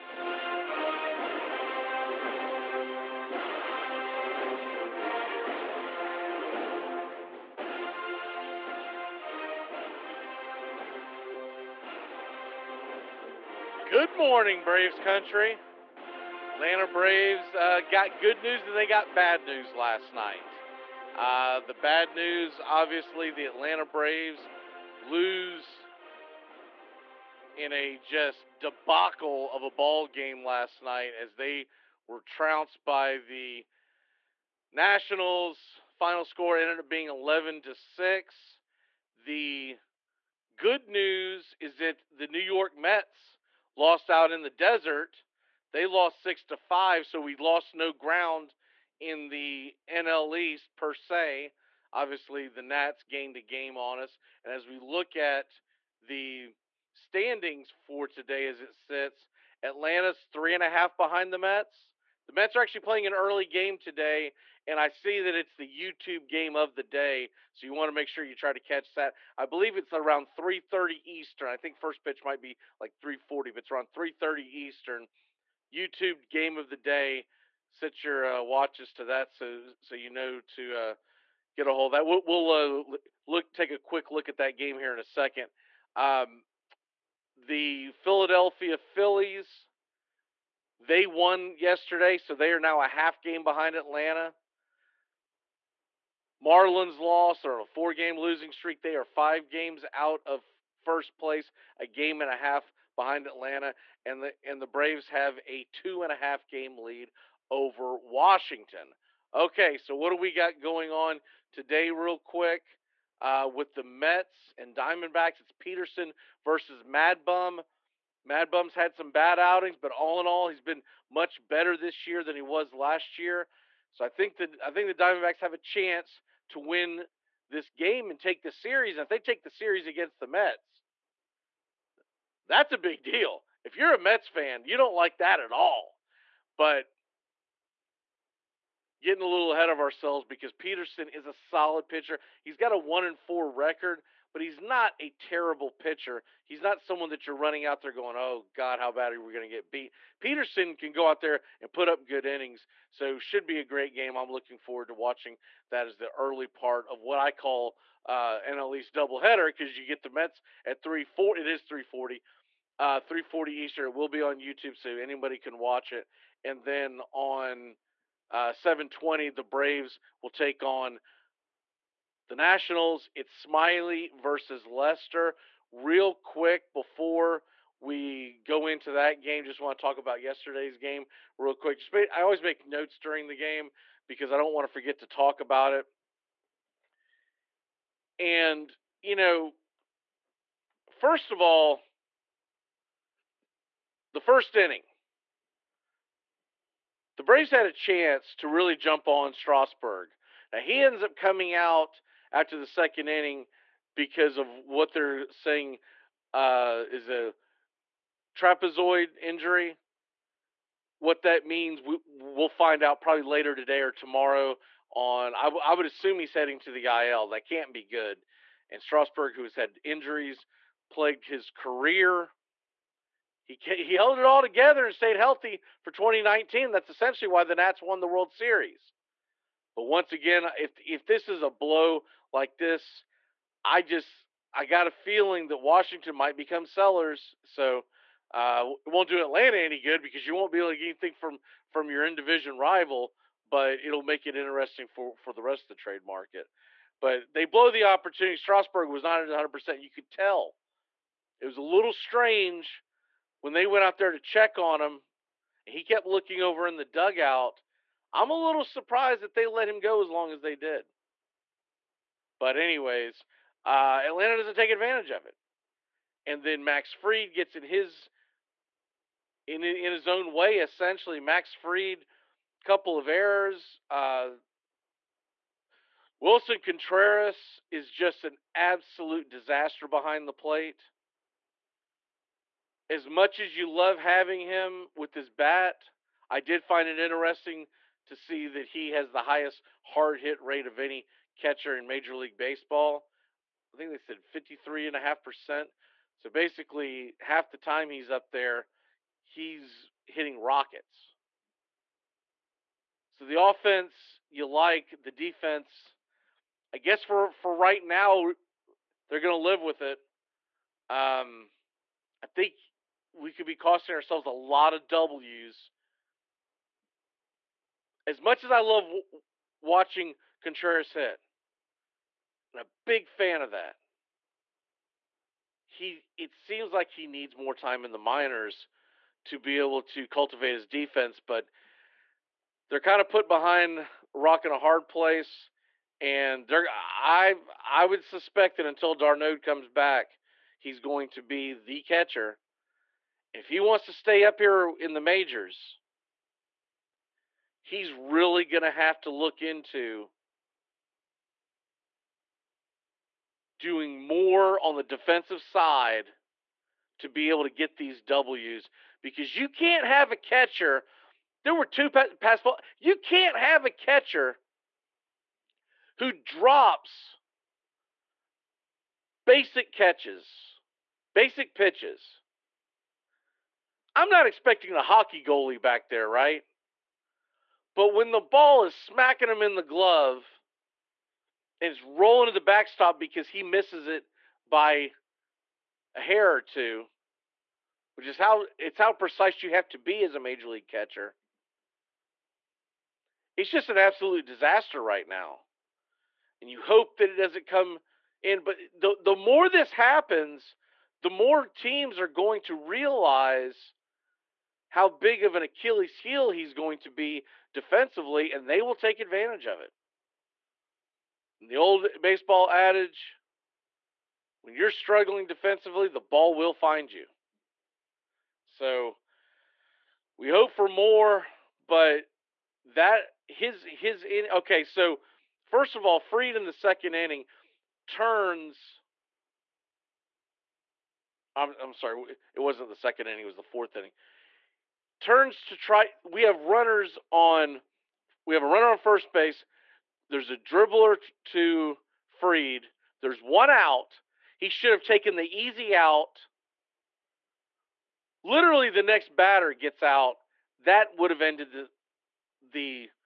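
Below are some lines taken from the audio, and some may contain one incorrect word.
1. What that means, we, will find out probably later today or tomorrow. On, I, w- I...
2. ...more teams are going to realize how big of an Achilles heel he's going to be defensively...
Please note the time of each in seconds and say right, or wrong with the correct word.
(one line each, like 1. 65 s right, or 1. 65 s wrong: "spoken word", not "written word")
1. 210 s right
2. 401 s right.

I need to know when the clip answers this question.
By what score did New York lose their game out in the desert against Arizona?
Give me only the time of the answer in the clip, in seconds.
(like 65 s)
46 s.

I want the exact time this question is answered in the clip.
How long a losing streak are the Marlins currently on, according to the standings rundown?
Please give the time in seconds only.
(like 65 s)
97 s.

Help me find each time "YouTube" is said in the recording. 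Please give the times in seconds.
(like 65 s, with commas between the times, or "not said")
65 s, 75 s, 164 s.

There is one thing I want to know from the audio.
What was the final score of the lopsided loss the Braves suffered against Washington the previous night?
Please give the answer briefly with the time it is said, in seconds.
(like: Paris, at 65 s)
11 to 6, at 37 s.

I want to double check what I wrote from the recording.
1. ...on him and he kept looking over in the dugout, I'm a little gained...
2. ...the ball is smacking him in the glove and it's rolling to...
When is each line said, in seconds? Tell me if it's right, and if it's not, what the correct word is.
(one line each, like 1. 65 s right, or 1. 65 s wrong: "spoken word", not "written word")
1. 254 s wrong: "surprised", not "gained"
2. 378 s right.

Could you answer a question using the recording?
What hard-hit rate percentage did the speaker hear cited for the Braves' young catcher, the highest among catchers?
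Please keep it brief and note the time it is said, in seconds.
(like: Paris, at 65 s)
53.5%, at 294 s.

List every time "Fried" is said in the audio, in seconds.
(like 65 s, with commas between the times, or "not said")
266 s, 271 s, 426 s, 442 s.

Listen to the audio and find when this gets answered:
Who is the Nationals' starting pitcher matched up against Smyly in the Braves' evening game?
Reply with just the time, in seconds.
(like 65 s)
174 s.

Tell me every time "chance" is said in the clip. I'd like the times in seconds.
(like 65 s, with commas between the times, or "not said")
125 s, 197 s.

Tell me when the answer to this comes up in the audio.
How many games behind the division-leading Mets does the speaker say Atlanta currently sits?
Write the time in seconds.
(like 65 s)
60 s.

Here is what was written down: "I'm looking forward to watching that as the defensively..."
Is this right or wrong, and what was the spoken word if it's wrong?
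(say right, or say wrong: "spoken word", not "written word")
wrong: "early", not "defensively".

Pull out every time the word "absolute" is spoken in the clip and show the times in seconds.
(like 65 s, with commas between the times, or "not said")
278 s, 393 s.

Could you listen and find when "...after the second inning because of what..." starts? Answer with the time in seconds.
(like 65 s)
202 s.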